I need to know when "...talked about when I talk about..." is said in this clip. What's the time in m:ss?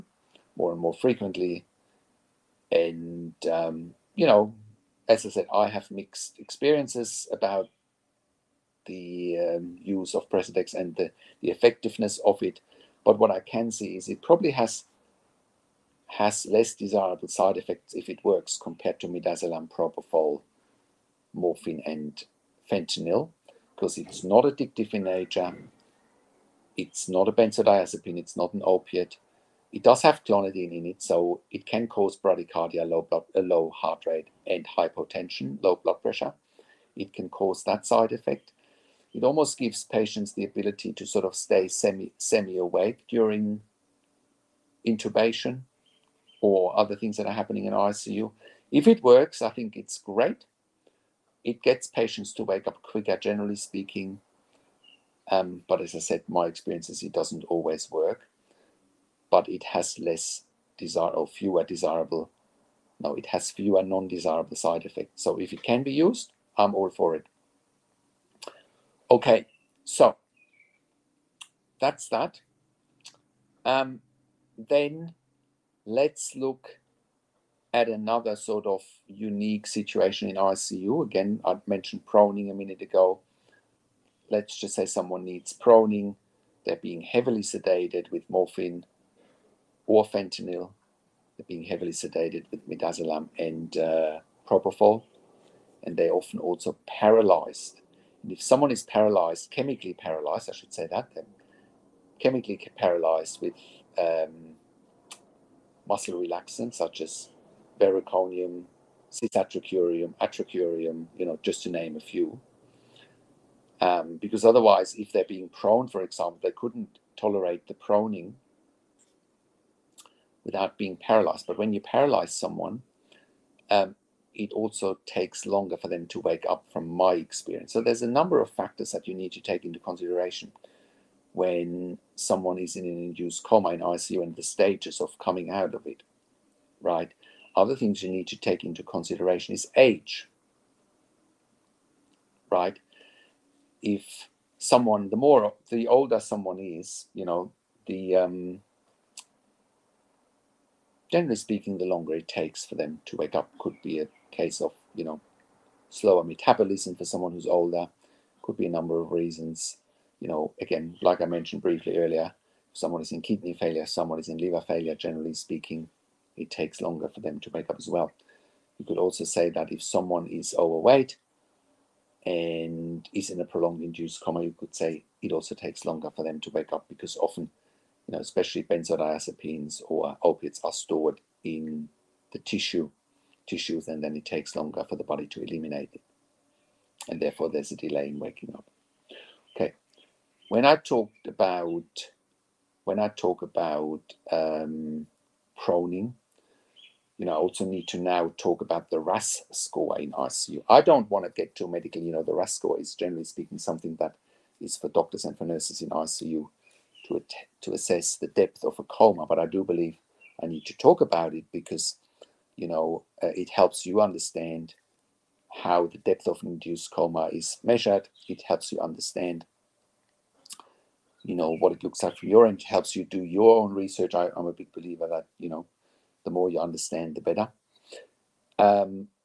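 3:10.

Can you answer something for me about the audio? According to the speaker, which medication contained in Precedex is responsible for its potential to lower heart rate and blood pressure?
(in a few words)
clonidine.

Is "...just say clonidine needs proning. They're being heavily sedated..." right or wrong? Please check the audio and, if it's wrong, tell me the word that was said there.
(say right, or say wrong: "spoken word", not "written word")
wrong: "someone", not "clonidine".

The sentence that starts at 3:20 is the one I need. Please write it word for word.
I don't want to get too medical.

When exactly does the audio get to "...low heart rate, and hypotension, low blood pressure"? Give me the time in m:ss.
0:33.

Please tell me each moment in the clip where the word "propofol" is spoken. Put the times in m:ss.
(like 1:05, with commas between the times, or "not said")
0:19, 1:34.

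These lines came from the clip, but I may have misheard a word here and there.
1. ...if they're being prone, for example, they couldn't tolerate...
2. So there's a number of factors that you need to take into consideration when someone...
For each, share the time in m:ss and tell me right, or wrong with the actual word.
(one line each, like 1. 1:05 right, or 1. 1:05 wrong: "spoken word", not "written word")
1. 1:54 right
2. 2:07 right.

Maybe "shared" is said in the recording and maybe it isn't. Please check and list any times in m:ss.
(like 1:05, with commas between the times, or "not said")
not said.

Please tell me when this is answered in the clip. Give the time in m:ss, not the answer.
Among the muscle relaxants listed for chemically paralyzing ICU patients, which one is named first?
1:47.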